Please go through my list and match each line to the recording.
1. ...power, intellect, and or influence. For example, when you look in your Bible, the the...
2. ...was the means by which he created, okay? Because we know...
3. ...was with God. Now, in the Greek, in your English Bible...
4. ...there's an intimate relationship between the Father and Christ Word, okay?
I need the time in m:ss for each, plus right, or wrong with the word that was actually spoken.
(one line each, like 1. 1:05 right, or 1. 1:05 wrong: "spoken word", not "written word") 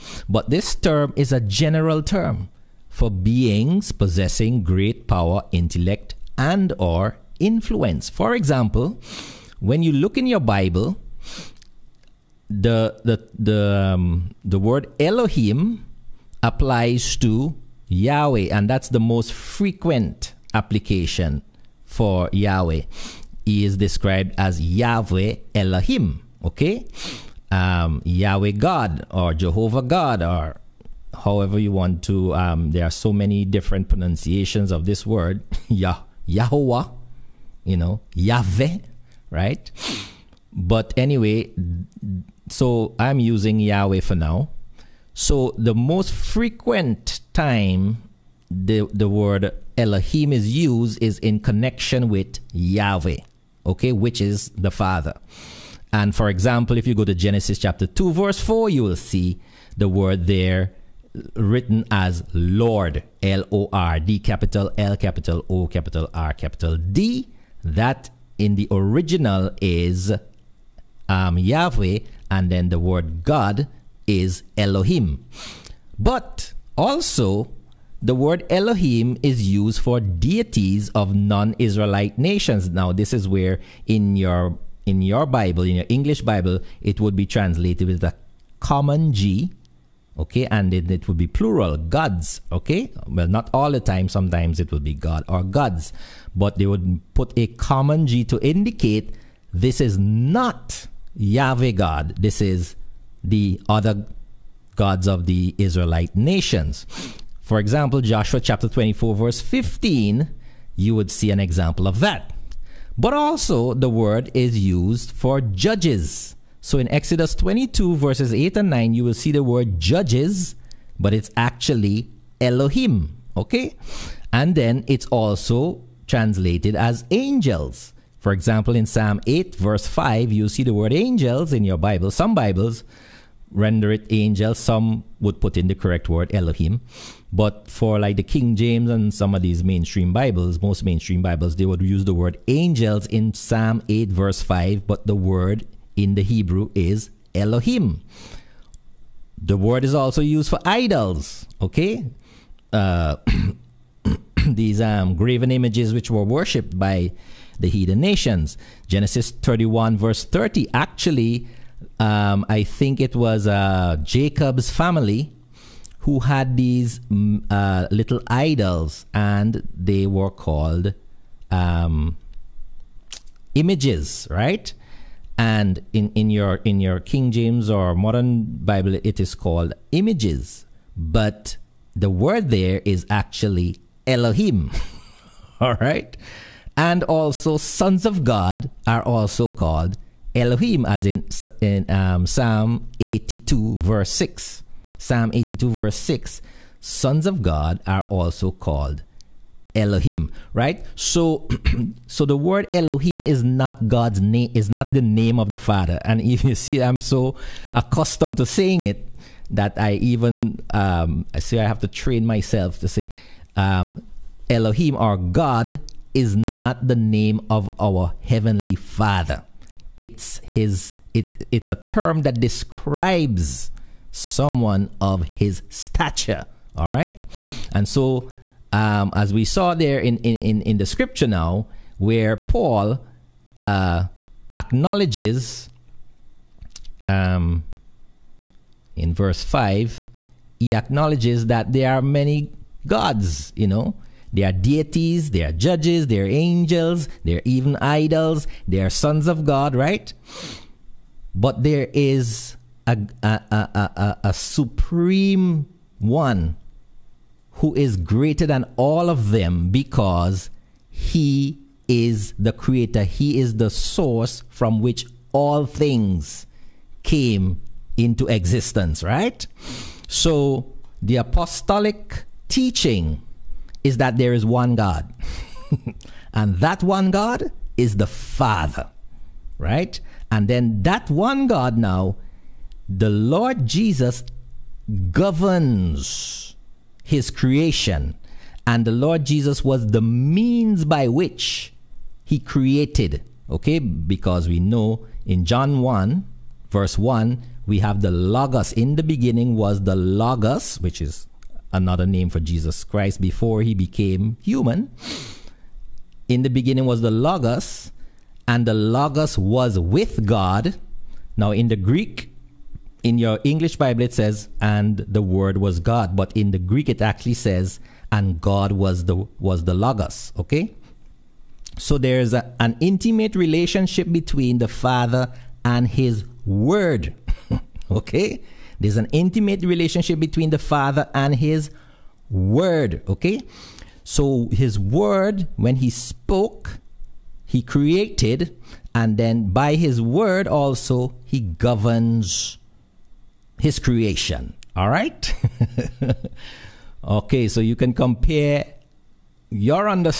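1. 0:05 right
2. 4:49 right
3. 5:09 right
4. 5:28 wrong: "His", not "Christ".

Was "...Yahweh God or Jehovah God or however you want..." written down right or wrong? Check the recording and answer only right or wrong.
right.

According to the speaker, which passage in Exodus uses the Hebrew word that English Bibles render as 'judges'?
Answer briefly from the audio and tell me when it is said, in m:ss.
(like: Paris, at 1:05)
Exodus 22:8-9, at 1:56.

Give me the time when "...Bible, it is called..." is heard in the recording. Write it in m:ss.
2:58.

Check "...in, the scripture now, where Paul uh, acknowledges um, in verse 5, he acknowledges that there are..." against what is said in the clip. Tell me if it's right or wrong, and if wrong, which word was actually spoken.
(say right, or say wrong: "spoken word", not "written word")
right.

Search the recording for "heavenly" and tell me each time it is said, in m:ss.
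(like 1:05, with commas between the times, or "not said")
3:38.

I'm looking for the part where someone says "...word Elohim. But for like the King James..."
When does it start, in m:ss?
2:16.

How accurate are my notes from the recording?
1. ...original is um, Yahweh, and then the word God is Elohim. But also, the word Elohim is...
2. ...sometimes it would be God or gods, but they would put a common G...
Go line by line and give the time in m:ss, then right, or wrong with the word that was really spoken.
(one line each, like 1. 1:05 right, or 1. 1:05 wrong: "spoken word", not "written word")
1. 1:08 right
2. 1:34 right.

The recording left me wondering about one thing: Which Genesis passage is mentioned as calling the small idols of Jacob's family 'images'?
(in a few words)
Genesis 31:30.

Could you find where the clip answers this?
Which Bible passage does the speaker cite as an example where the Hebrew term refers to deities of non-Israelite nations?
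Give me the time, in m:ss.
1:48.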